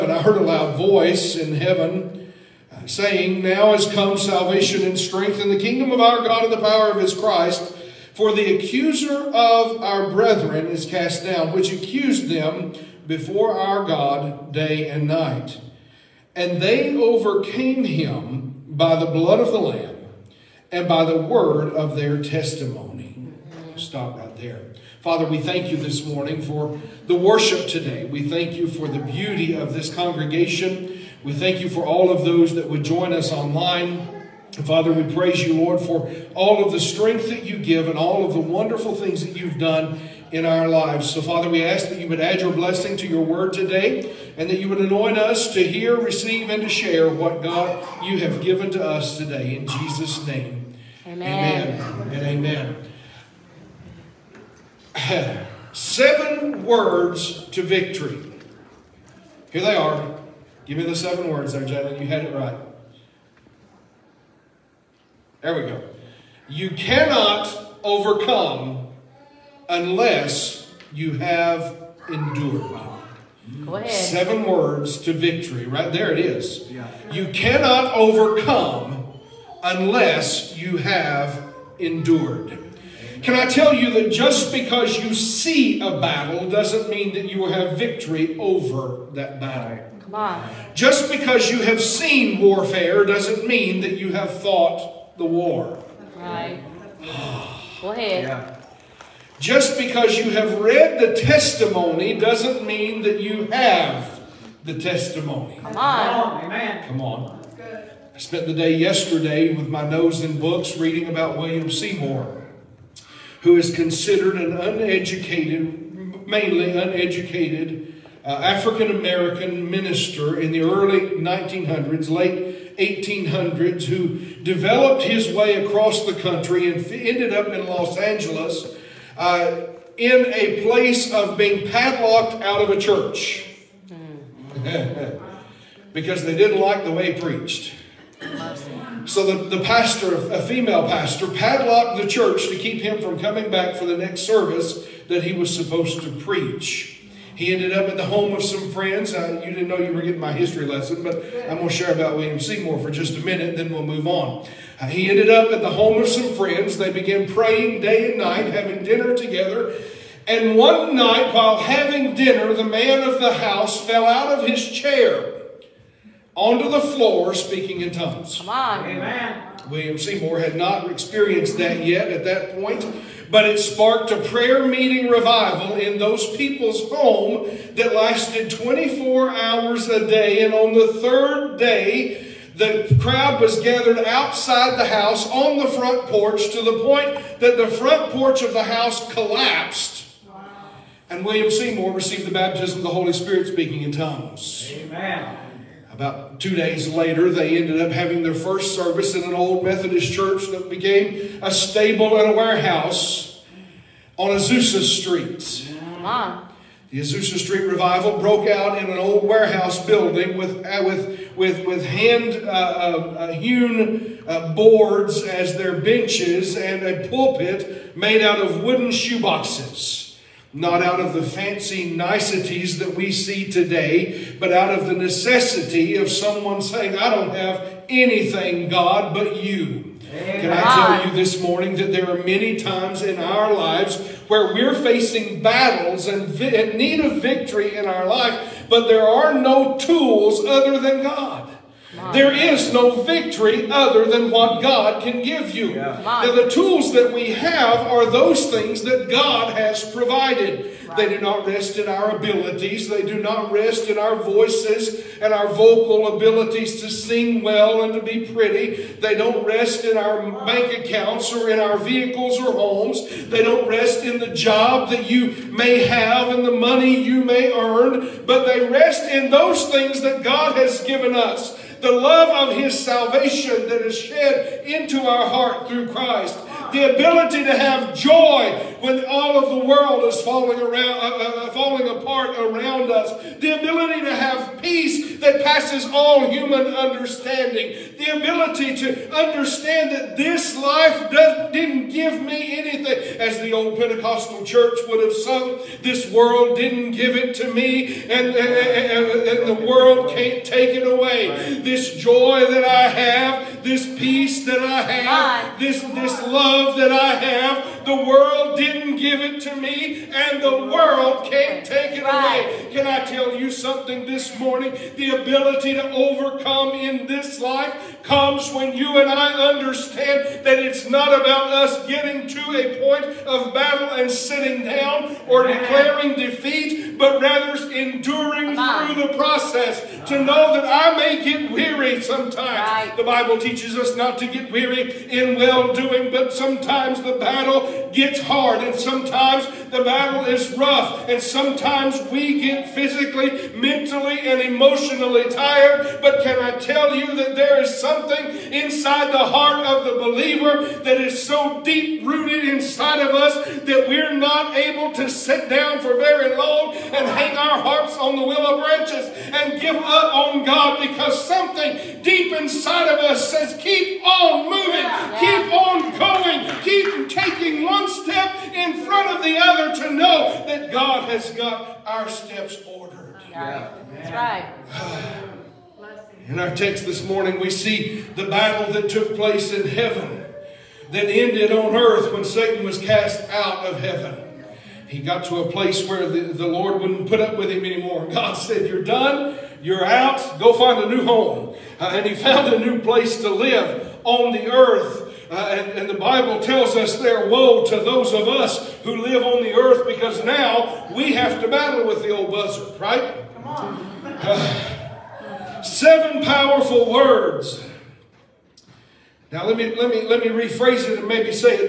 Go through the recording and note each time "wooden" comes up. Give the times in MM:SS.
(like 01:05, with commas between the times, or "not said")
03:38.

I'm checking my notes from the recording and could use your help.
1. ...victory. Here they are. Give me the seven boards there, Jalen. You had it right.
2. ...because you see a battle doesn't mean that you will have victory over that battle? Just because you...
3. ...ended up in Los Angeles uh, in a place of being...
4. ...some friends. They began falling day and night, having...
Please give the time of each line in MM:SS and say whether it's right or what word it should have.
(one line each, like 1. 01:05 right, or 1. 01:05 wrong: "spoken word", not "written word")
1. 00:57 wrong: "words", not "boards"
2. 01:24 right
3. 02:06 right
4. 02:36 wrong: "praying", not "falling".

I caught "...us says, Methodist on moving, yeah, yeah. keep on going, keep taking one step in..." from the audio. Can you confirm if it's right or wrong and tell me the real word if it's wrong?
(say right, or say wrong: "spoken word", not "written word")
wrong: "Keep", not "Methodist".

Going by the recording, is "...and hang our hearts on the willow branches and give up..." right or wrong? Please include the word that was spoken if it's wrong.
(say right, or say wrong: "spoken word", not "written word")
right.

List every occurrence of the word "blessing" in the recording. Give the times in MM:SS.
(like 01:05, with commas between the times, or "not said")
00:42.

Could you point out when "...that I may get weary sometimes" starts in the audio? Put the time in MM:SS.
05:30.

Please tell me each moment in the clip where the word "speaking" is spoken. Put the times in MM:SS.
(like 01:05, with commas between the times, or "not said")
02:47, 03:13.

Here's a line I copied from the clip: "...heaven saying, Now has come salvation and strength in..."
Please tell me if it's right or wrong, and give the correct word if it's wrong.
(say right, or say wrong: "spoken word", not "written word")
right.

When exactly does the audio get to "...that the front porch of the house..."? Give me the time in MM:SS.
03:07.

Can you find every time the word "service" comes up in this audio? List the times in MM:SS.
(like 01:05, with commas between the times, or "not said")
02:24, 03:18.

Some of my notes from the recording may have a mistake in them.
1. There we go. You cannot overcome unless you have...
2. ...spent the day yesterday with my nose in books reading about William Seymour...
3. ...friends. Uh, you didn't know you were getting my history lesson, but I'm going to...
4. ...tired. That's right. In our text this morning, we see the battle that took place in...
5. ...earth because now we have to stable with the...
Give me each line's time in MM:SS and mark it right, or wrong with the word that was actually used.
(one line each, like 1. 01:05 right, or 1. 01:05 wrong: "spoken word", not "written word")
1. 01:05 right
2. 01:48 right
3. 02:28 right
4. 06:12 wrong: "ordered", not "tired"
5. 06:39 wrong: "battle", not "stable".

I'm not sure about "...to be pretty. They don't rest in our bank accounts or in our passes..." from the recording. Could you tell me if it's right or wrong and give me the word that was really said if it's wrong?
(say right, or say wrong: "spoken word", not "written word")
wrong: "vehicles", not "passes".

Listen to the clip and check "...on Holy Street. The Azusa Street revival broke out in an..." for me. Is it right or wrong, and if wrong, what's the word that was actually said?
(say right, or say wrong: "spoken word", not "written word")
wrong: "Azusa", not "Holy".